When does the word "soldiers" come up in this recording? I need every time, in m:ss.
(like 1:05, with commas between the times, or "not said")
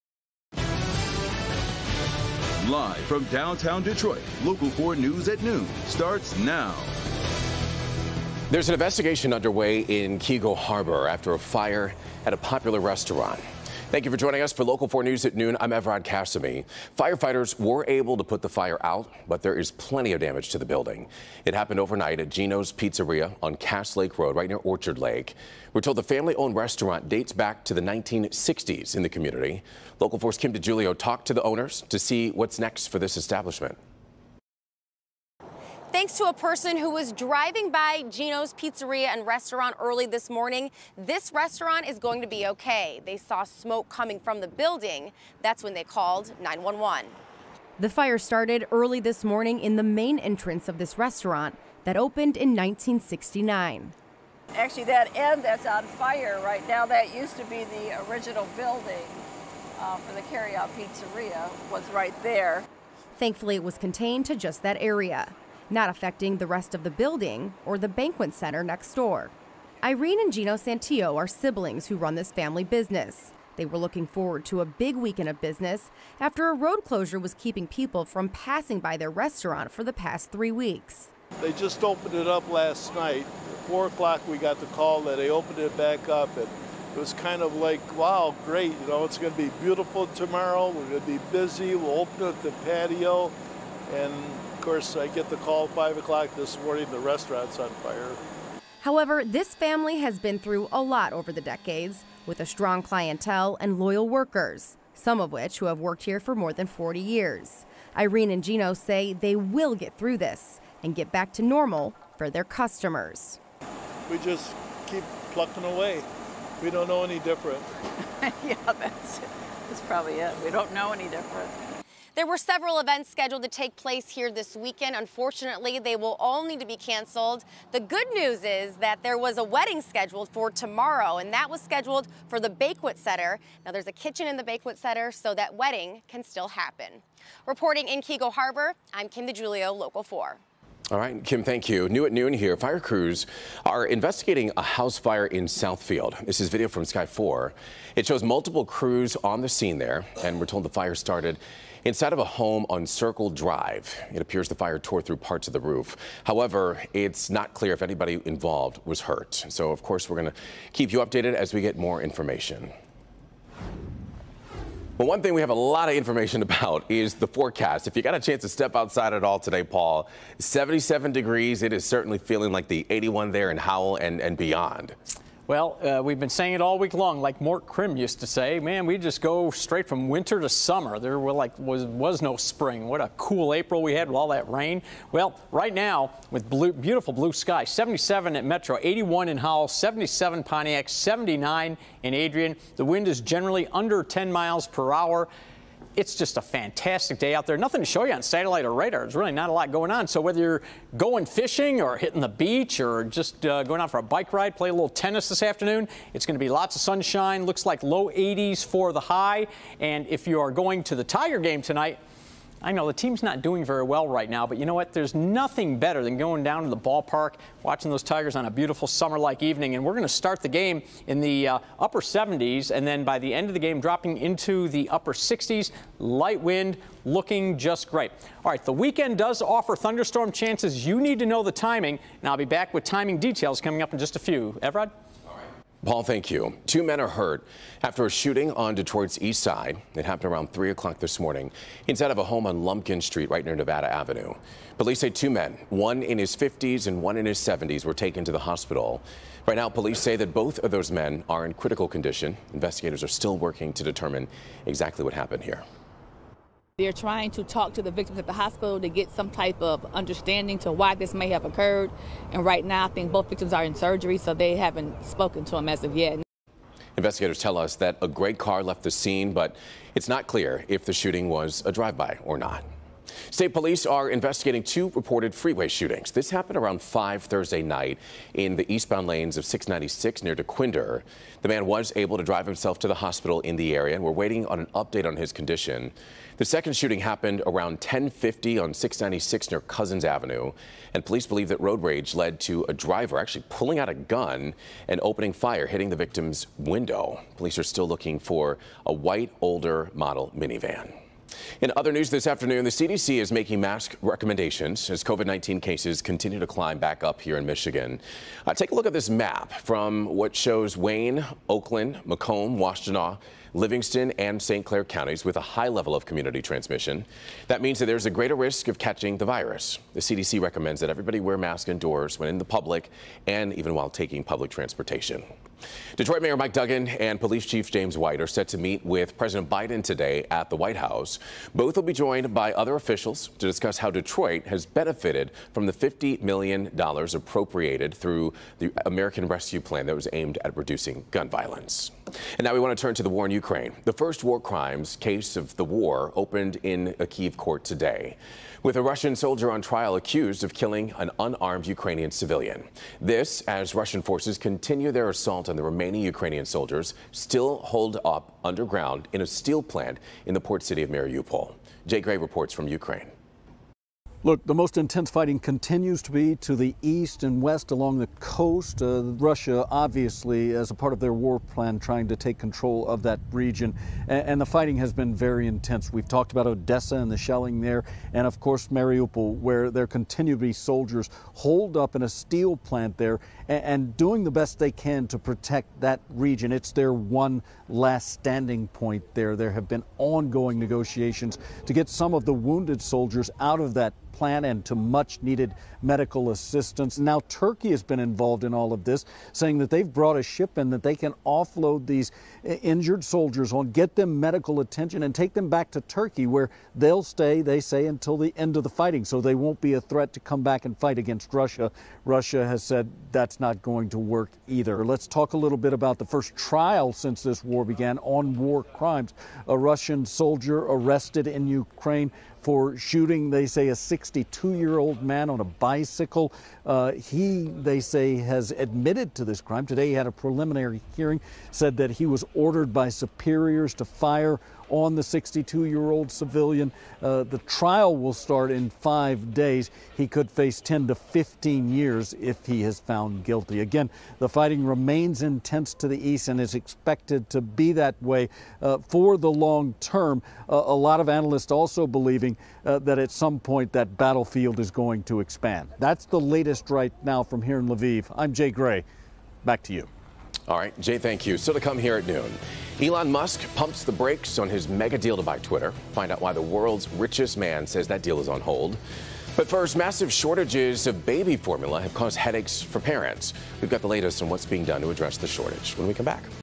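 5:49, 5:56, 6:20, 6:32, 6:43, 7:00.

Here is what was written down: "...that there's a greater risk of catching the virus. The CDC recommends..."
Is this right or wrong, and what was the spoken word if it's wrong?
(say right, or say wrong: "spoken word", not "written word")
right.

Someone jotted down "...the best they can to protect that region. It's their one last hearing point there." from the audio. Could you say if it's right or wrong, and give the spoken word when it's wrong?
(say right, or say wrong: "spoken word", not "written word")
wrong: "standing", not "hearing".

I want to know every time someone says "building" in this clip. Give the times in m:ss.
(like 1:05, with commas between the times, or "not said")
0:20, 0:44, 0:58, 1:06.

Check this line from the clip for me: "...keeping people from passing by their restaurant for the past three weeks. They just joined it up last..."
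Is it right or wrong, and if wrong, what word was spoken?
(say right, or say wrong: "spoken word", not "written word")
wrong: "opened", not "joined".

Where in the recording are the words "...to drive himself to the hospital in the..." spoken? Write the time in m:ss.
4:42.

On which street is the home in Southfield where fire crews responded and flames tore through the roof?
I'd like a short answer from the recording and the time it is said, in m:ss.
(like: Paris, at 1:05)
Circle Drive, at 2:32.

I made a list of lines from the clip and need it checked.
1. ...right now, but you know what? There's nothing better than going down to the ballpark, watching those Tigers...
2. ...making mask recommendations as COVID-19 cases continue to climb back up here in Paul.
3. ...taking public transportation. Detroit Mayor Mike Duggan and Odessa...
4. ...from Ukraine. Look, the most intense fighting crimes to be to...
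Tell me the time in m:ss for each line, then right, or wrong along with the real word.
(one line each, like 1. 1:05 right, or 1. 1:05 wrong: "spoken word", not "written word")
1. 3:34 right
2. 5:03 wrong: "Michigan", not "Paul"
3. 5:23 wrong: "Police", not "Odessa"
4. 6:02 wrong: "continues", not "crimes".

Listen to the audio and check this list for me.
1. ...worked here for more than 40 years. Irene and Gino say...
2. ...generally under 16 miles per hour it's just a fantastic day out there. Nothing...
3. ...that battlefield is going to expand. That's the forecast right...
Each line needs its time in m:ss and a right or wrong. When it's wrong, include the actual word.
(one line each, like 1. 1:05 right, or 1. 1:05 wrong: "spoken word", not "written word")
1. 1:45 right
2. 3:13 wrong: "10", not "16"
3. 7:33 wrong: "latest", not "forecast".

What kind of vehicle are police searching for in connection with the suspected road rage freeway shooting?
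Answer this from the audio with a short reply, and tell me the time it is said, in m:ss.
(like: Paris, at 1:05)
white older model minivan, at 4:58.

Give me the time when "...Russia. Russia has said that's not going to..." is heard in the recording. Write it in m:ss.
6:51.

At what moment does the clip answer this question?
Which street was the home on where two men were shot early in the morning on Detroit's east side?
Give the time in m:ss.
4:02.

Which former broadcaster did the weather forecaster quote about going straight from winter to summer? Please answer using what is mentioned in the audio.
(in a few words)
Mort Crim.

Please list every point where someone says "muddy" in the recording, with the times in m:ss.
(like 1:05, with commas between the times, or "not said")
not said.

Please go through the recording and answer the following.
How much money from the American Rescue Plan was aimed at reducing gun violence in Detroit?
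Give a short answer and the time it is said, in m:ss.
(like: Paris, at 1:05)
$50 million, at 5:35.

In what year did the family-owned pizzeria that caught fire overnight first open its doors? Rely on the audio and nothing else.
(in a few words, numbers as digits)
1969.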